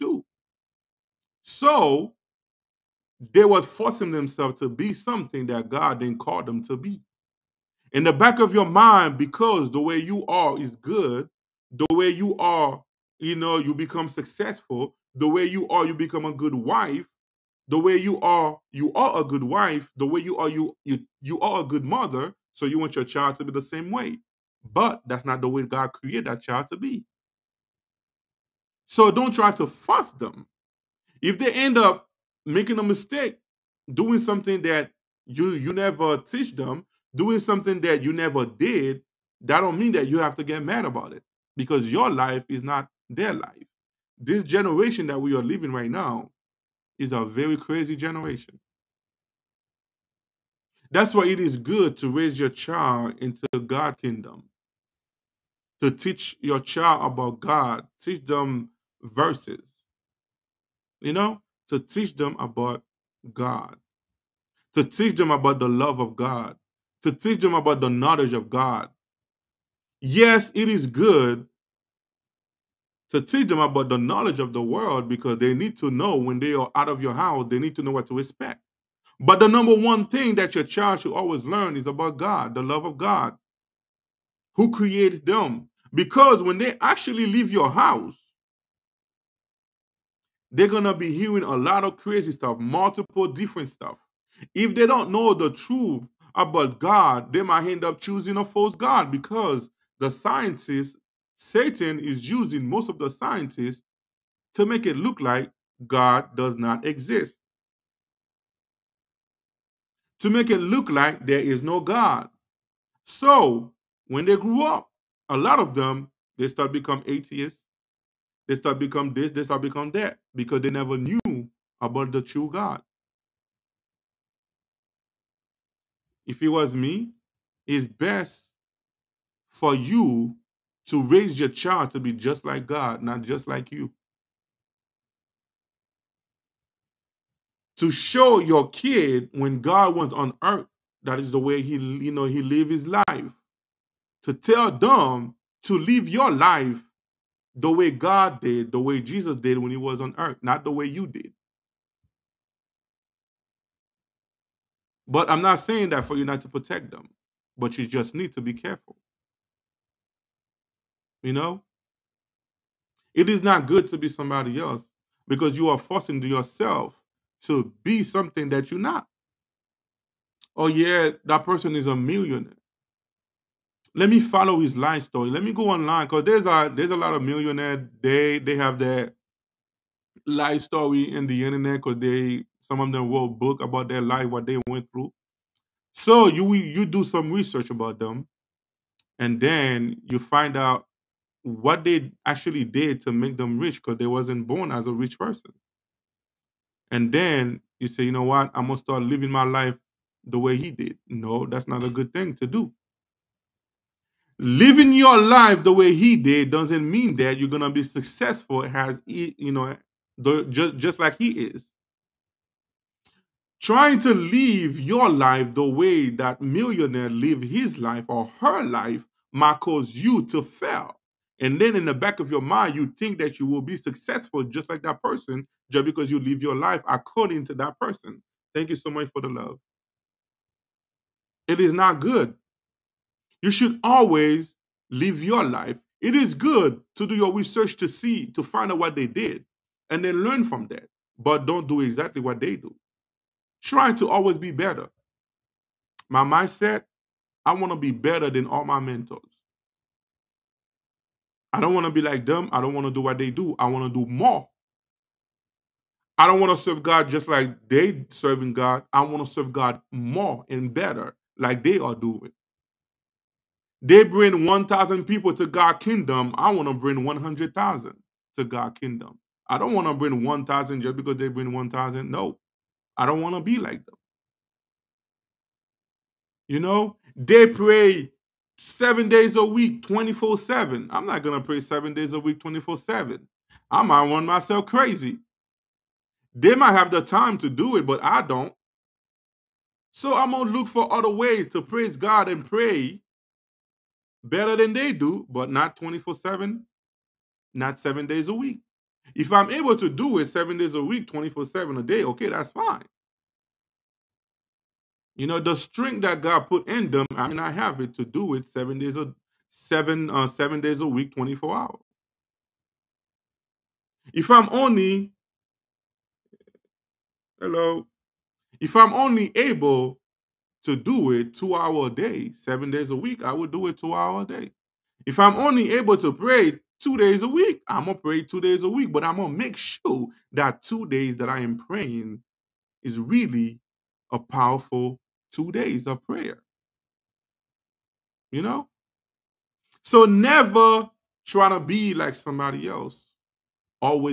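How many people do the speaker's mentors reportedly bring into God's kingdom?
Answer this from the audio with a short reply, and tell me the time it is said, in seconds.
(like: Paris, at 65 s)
1,000, at 264 s.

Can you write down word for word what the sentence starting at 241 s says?
But don't do exactly what they do.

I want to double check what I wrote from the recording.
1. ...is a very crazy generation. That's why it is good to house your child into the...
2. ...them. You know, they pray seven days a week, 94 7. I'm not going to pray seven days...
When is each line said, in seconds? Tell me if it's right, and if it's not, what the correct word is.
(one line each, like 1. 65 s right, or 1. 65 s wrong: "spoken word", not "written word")
1. 46 s wrong: "raise", not "house"
2. 273 s wrong: "24", not "94".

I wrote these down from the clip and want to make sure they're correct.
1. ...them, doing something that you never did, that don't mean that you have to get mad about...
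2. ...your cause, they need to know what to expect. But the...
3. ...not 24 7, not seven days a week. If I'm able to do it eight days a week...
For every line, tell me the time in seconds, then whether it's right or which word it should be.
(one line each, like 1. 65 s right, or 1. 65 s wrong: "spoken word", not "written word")
1. 36 s right
2. 77 s wrong: "house", not "cause"
3. 295 s wrong: "seven", not "eight".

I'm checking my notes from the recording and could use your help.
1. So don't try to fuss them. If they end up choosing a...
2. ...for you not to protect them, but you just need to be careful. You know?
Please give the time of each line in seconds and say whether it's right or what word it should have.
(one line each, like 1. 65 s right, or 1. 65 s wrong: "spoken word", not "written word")
1. 28 s wrong: "making", not "choosing"
2. 156 s right.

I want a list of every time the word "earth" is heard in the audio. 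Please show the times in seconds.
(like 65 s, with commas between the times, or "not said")
140 s, 150 s.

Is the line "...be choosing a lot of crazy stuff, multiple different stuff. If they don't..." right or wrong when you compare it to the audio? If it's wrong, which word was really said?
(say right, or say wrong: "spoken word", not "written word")
wrong: "hearing", not "choosing".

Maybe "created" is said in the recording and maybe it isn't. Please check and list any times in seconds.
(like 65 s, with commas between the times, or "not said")
25 s, 84 s.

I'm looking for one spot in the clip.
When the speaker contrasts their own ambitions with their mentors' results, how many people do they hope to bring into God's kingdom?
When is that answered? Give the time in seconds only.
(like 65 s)
267 s.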